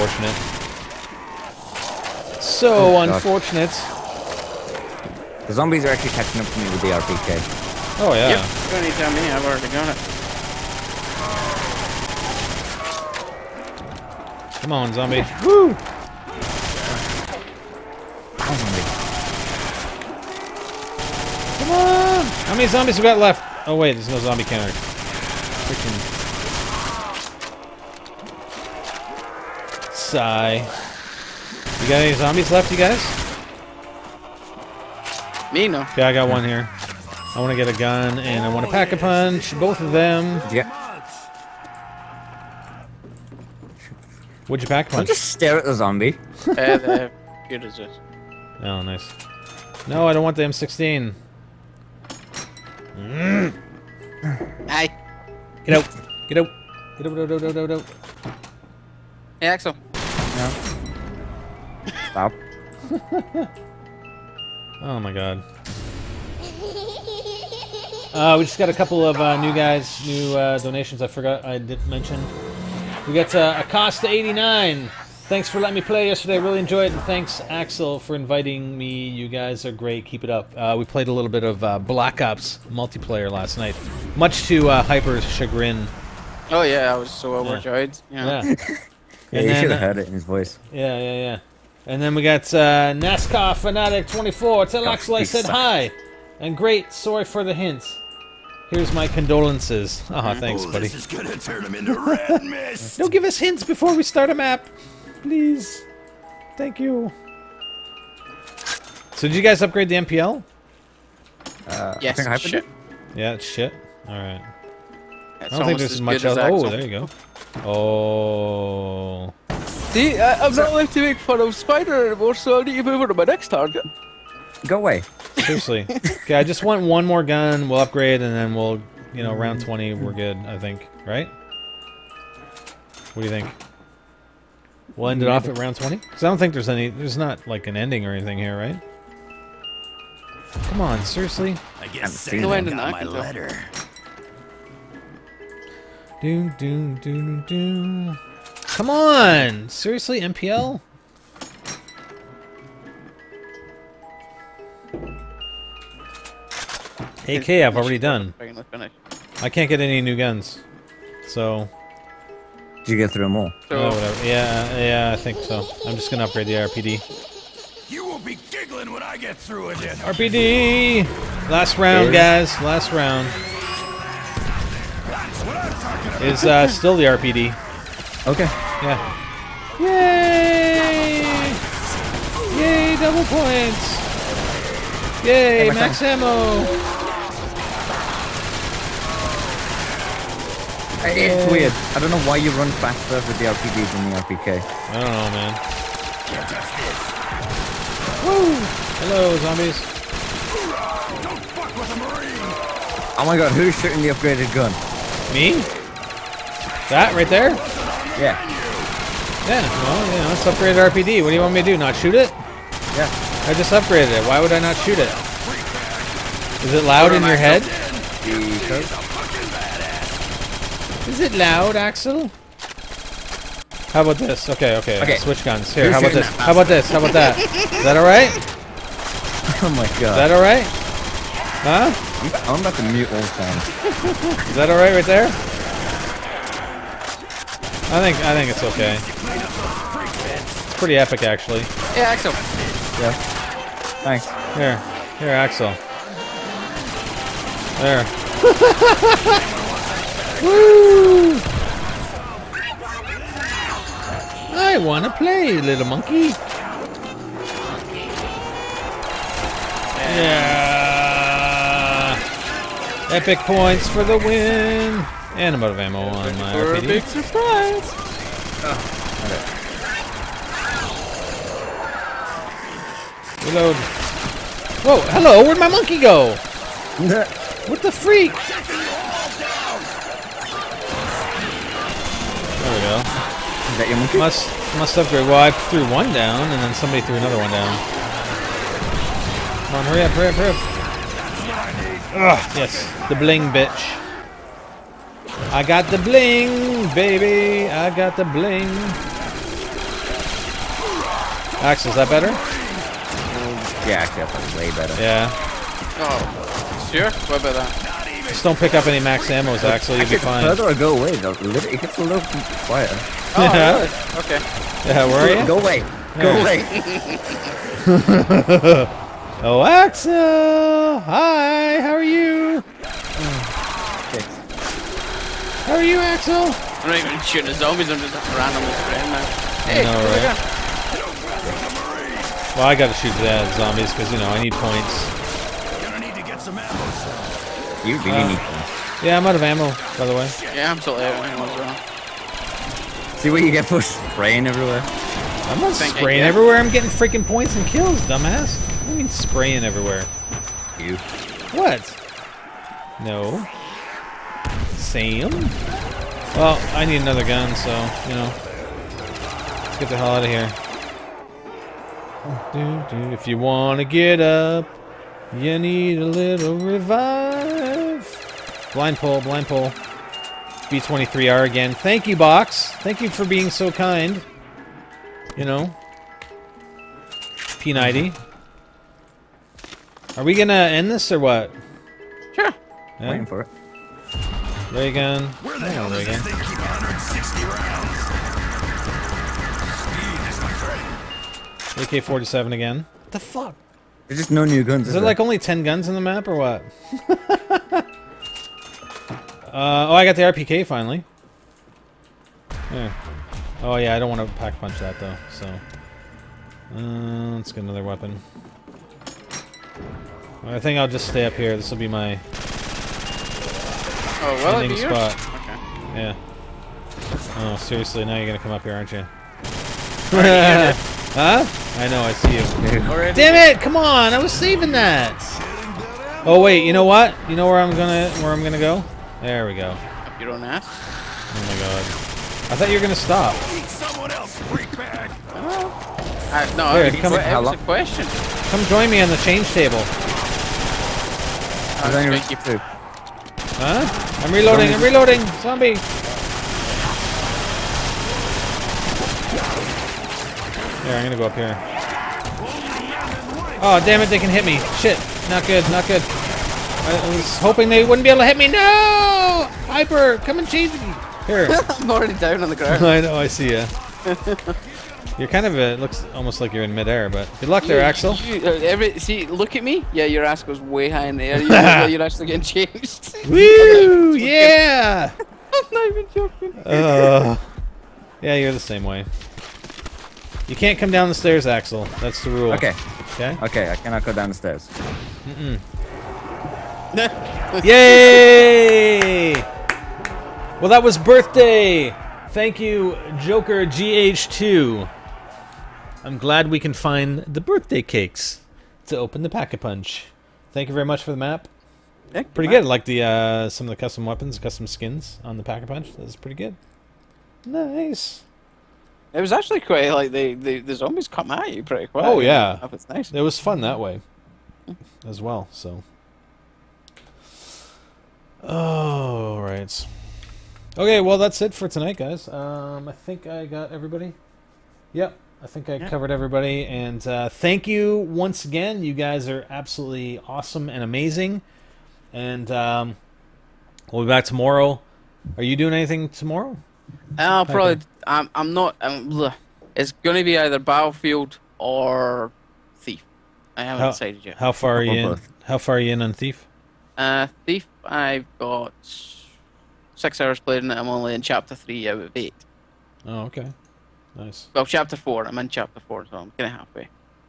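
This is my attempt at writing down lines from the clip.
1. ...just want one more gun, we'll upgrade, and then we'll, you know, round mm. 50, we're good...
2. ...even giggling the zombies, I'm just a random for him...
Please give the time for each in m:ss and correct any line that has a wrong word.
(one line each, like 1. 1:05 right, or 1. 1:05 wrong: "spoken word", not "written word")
1. 2:06 wrong: "20", not "50"
2. 5:27 wrong: "shooting", not "giggling".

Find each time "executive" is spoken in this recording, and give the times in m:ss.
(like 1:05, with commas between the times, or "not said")
not said.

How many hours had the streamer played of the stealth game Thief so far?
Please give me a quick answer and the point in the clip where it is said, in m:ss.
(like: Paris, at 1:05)
6, at 9:09.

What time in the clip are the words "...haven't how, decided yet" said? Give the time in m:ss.
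9:03.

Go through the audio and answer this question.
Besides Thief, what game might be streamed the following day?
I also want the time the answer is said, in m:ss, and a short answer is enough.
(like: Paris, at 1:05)
Battlefield, at 9:00.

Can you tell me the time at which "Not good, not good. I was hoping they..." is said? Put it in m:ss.
7:35.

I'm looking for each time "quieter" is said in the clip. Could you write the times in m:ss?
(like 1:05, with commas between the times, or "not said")
5:12.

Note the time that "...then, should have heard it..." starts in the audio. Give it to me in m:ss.
1:29.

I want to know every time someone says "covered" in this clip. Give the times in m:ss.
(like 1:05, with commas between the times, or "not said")
8:45.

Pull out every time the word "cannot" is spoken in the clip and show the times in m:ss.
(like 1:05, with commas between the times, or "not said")
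8:03.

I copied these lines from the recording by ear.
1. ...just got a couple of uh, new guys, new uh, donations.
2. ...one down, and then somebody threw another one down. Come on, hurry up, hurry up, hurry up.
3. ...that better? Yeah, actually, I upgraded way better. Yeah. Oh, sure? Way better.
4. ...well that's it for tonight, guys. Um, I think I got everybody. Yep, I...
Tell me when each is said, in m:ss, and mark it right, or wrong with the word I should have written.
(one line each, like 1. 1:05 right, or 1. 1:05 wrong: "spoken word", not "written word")
1. 1:08 right
2. 4:45 right
3. 5:01 wrong: "played", not "upgraded"
4. 8:40 right.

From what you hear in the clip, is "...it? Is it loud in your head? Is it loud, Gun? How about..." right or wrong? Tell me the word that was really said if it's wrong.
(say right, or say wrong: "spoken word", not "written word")
wrong: "Axel", not "Gun".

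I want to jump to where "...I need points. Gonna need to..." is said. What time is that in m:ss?
5:34.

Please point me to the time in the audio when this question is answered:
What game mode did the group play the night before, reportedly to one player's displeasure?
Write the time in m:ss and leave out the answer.
1:21.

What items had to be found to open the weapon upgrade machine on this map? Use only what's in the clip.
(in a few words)
birthday cakes.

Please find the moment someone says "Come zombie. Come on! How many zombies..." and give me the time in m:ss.
0:18.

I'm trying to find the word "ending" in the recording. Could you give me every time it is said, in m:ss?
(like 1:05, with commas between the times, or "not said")
2:17, 6:54.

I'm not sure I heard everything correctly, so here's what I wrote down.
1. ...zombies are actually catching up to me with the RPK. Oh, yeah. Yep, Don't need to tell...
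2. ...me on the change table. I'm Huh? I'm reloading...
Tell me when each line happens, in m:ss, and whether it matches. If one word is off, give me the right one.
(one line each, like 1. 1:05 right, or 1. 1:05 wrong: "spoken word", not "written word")
1. 0:05 right
2. 7:18 right.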